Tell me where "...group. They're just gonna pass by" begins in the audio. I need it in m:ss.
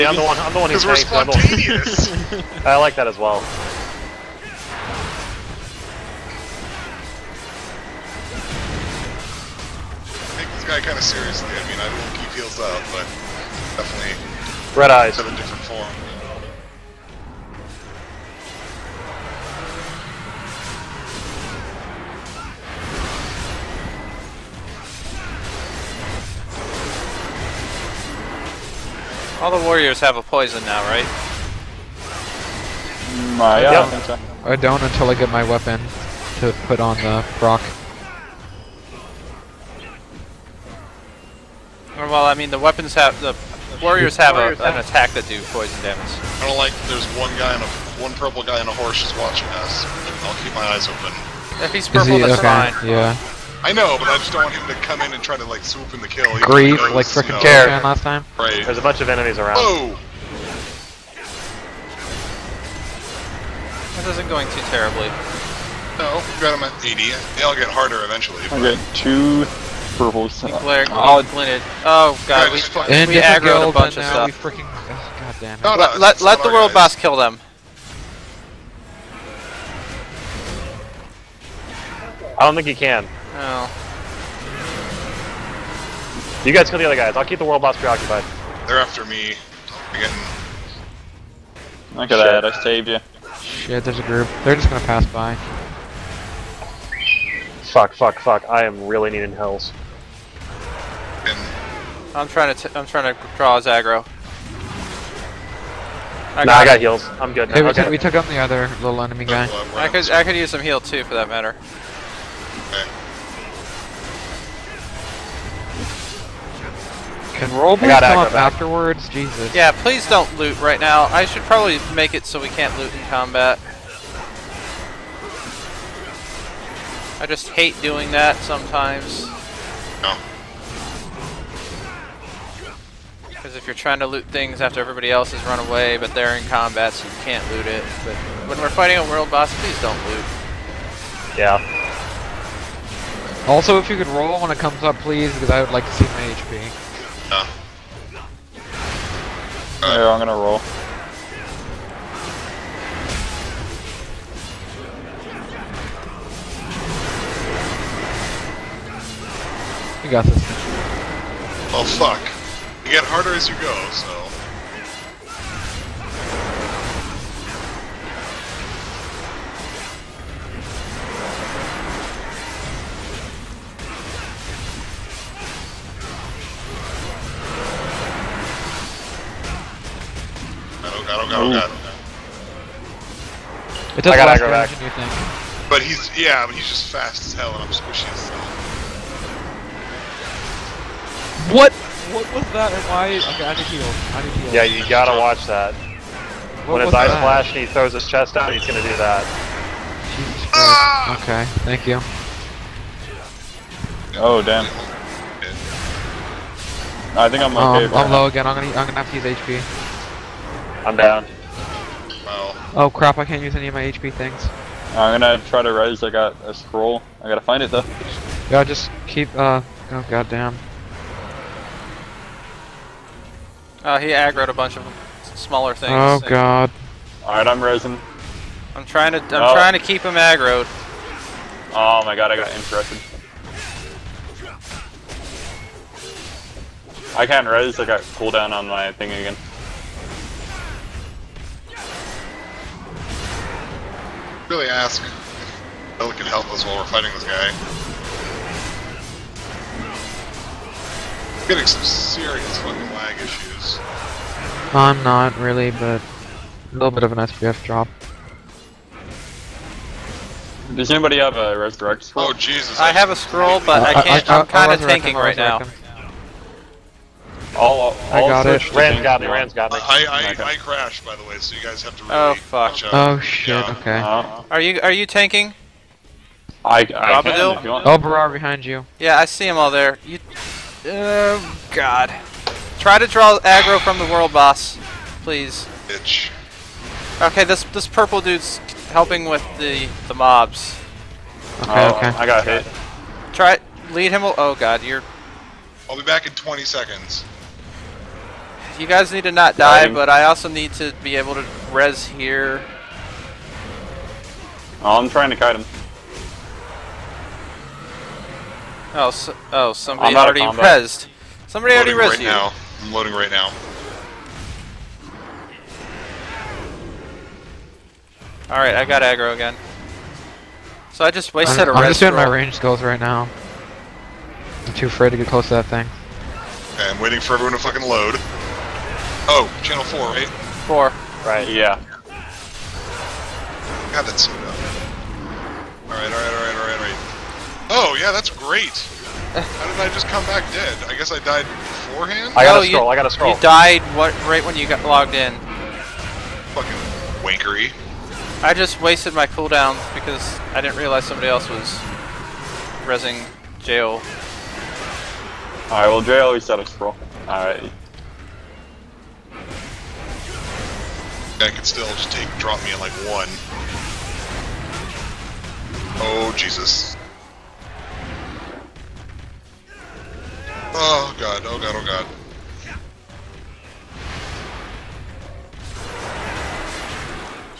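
1:34.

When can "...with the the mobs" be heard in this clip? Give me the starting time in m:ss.
4:49.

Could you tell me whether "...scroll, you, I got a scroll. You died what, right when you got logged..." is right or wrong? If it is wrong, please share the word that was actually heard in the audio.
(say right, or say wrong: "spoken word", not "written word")
right.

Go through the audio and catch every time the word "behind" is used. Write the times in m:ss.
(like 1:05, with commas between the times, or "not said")
4:38.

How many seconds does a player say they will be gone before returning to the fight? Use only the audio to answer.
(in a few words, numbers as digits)
20.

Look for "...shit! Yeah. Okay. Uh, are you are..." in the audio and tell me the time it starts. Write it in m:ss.
4:33.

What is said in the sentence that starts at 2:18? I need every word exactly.
But when we're fighting a world boss, please don't loot.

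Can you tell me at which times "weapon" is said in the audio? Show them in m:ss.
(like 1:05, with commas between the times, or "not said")
0:35, 0:42.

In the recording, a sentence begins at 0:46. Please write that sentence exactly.
I don't like there's one guy on a one purple guy on a horse just watching us.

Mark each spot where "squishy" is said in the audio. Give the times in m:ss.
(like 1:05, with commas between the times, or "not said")
3:07.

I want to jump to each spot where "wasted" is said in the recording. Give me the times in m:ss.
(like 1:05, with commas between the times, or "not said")
5:21, 5:48.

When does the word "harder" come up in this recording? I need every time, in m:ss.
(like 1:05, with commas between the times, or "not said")
1:07, 2:43.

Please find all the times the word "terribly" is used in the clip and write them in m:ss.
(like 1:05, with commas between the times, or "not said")
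1:04.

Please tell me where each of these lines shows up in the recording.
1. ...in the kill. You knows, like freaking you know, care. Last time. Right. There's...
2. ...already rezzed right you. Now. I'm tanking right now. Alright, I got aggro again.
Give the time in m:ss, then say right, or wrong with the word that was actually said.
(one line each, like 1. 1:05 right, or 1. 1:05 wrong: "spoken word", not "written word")
1. 0:55 right
2. 5:11 wrong: "loading", not "tanking".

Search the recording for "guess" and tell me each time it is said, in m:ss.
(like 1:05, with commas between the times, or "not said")
5:40.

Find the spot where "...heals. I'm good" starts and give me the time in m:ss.
1:46.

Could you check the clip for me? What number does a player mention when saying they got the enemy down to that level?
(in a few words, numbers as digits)
80.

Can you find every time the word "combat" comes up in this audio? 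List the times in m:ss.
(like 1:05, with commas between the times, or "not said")
2:03, 2:16.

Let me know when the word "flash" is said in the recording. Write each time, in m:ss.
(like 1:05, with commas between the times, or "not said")
3:17.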